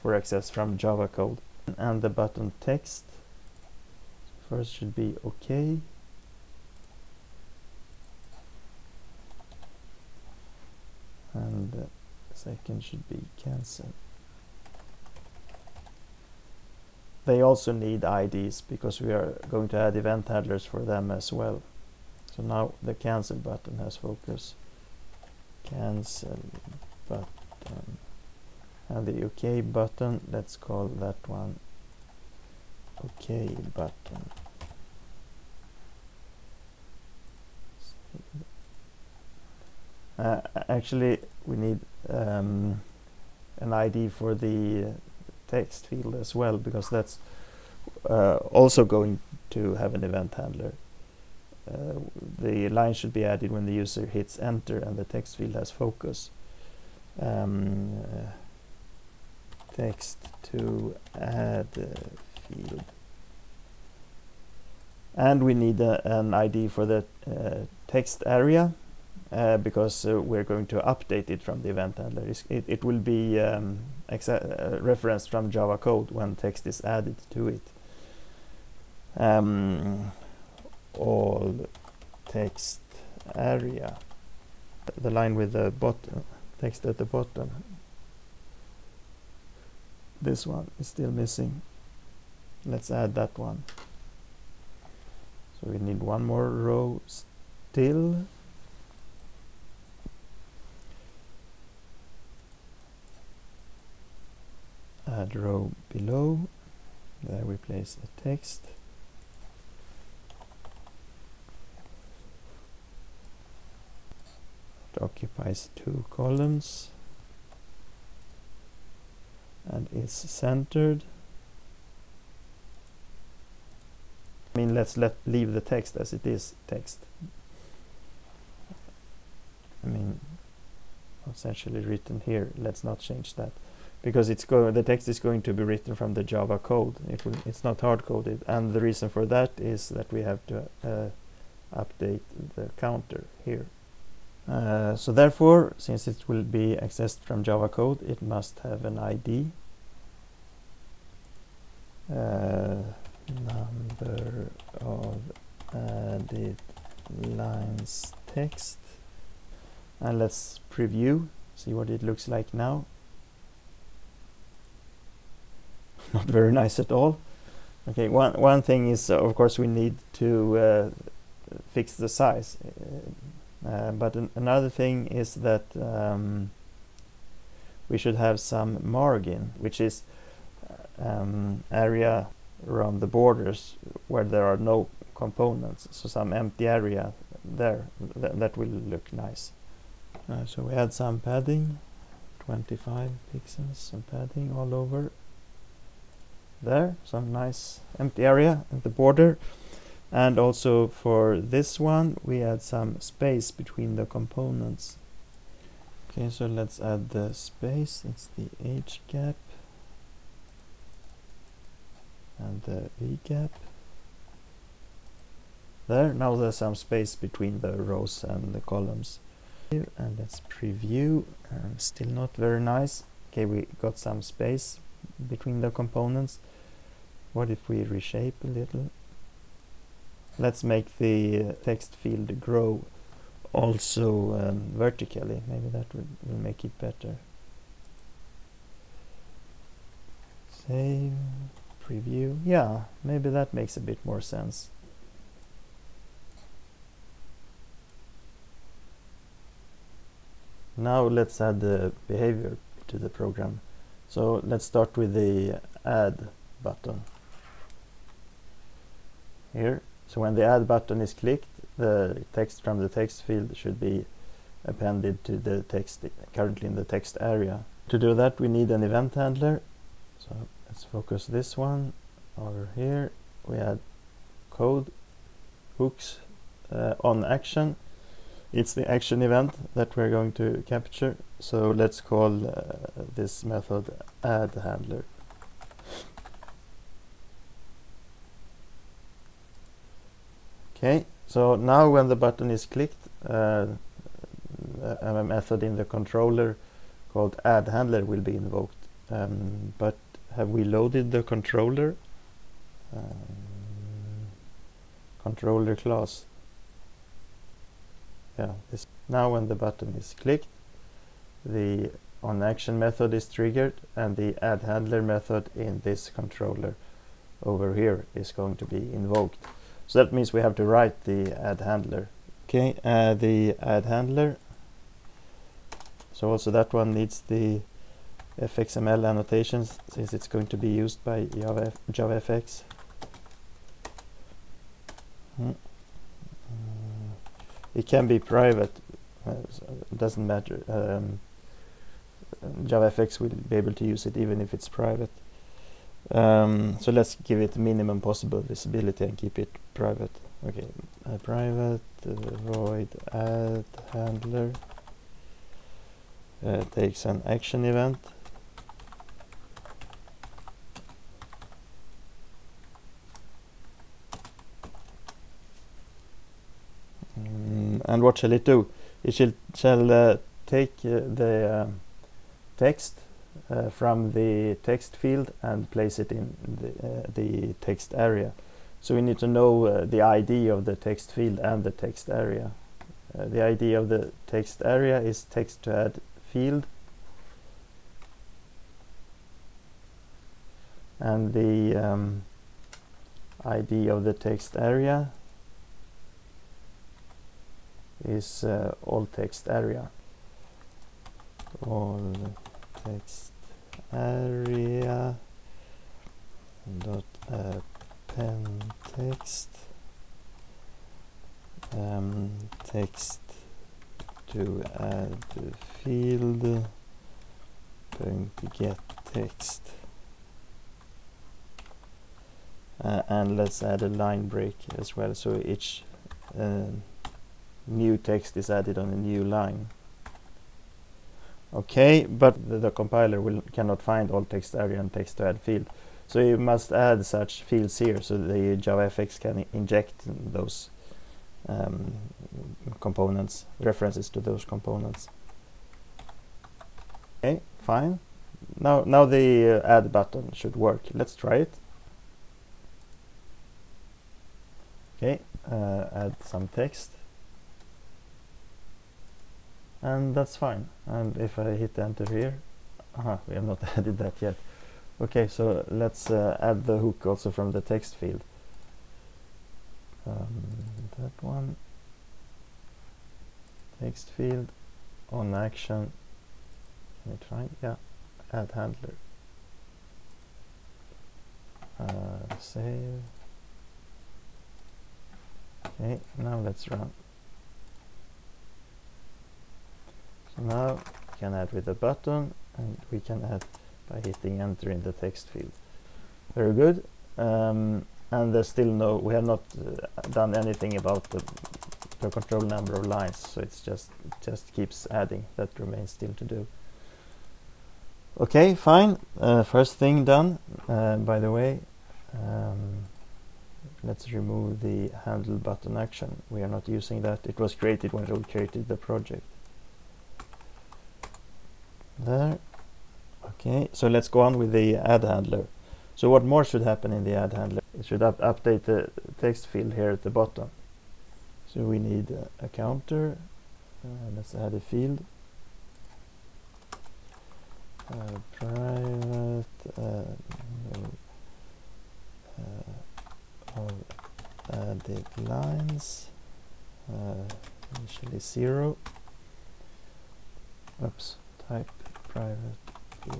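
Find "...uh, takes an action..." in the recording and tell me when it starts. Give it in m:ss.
5:56.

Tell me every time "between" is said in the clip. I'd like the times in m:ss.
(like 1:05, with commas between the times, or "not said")
3:23, 3:37, 3:45.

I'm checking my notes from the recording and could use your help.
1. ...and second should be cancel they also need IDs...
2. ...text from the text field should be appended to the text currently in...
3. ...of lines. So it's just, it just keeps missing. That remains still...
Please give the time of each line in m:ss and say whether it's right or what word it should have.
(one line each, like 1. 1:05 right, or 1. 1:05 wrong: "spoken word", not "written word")
1. 0:11 right
2. 4:22 right
3. 8:22 wrong: "adding", not "missing".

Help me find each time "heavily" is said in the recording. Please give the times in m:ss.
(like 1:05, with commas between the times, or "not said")
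not said.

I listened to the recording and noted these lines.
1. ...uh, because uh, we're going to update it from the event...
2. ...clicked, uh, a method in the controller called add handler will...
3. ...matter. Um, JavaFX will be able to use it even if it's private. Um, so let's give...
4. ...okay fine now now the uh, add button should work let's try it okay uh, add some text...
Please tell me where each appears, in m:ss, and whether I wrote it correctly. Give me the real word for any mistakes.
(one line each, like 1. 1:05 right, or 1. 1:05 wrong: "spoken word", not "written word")
1. 1:09 right
2. 4:52 right
3. 5:40 right
4. 7:27 right.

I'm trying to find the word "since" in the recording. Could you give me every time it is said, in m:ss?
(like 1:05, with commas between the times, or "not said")
2:25, 5:29.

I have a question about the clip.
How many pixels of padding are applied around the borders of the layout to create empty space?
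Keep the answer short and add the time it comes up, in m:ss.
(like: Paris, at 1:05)
25, at 3:12.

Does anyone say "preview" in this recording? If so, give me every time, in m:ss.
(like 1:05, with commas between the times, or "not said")
2:40, 3:40, 4:01.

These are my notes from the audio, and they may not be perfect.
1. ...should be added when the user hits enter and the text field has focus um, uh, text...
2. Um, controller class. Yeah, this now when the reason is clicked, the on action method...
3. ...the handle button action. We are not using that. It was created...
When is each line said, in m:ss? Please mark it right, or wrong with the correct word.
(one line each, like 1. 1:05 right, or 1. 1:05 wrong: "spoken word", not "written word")
1. 0:52 right
2. 5:02 wrong: "button", not "reason"
3. 8:34 right.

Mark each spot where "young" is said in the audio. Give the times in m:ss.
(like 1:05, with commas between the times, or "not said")
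not said.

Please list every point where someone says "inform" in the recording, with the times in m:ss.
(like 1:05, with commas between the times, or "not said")
not said.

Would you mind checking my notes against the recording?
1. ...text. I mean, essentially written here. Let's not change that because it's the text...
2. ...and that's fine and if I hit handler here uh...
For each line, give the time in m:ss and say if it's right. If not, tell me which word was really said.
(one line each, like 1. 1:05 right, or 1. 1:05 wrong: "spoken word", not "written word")
1. 2:06 right
2. 7:39 wrong: "enter", not "handler".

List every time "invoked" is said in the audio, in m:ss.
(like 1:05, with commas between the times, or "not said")
4:58, 5:18.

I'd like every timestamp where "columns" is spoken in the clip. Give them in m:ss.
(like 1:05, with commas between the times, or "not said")
1:56, 3:38.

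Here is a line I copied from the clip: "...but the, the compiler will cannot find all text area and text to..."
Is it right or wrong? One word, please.
right.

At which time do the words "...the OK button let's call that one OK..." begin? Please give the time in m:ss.
0:29.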